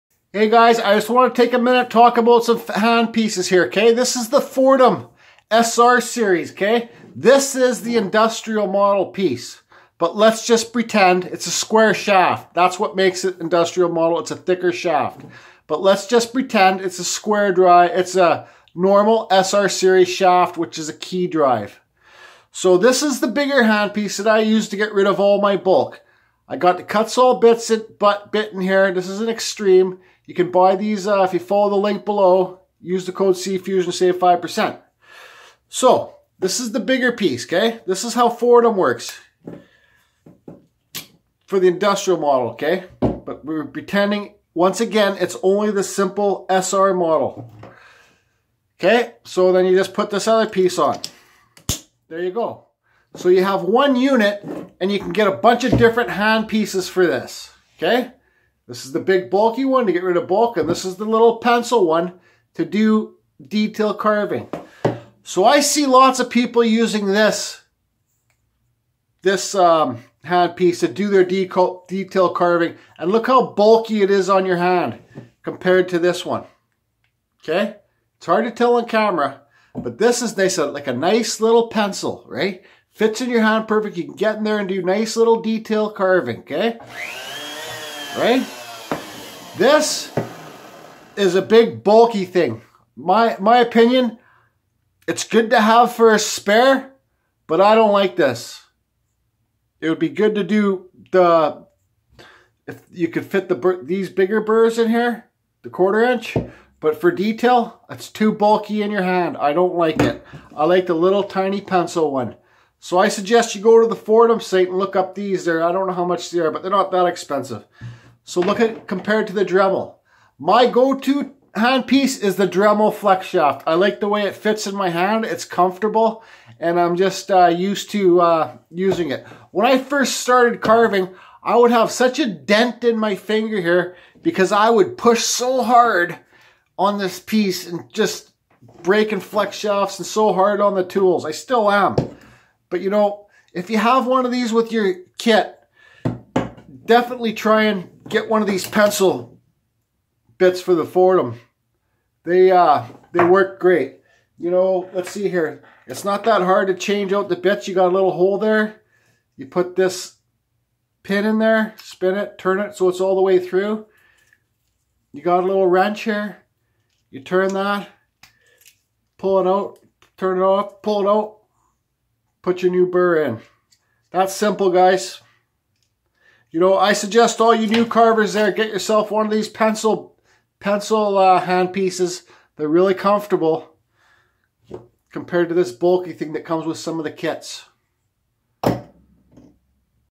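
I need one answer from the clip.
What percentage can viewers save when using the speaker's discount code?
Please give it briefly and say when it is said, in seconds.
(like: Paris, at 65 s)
5%, at 34 s.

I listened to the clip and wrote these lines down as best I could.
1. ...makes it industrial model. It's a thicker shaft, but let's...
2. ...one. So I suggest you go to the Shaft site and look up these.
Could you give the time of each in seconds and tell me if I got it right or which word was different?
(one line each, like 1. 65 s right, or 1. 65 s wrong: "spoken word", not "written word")
1. 12 s right
2. 112 s wrong: "Foredom", not "Shaft".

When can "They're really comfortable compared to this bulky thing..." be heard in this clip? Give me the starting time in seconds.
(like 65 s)
182 s.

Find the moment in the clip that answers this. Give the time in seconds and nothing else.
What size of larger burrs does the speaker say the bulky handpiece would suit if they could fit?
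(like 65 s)
105 s.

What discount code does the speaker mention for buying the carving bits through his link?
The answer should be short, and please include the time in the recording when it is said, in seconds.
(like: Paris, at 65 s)
CFusion, at 33 s.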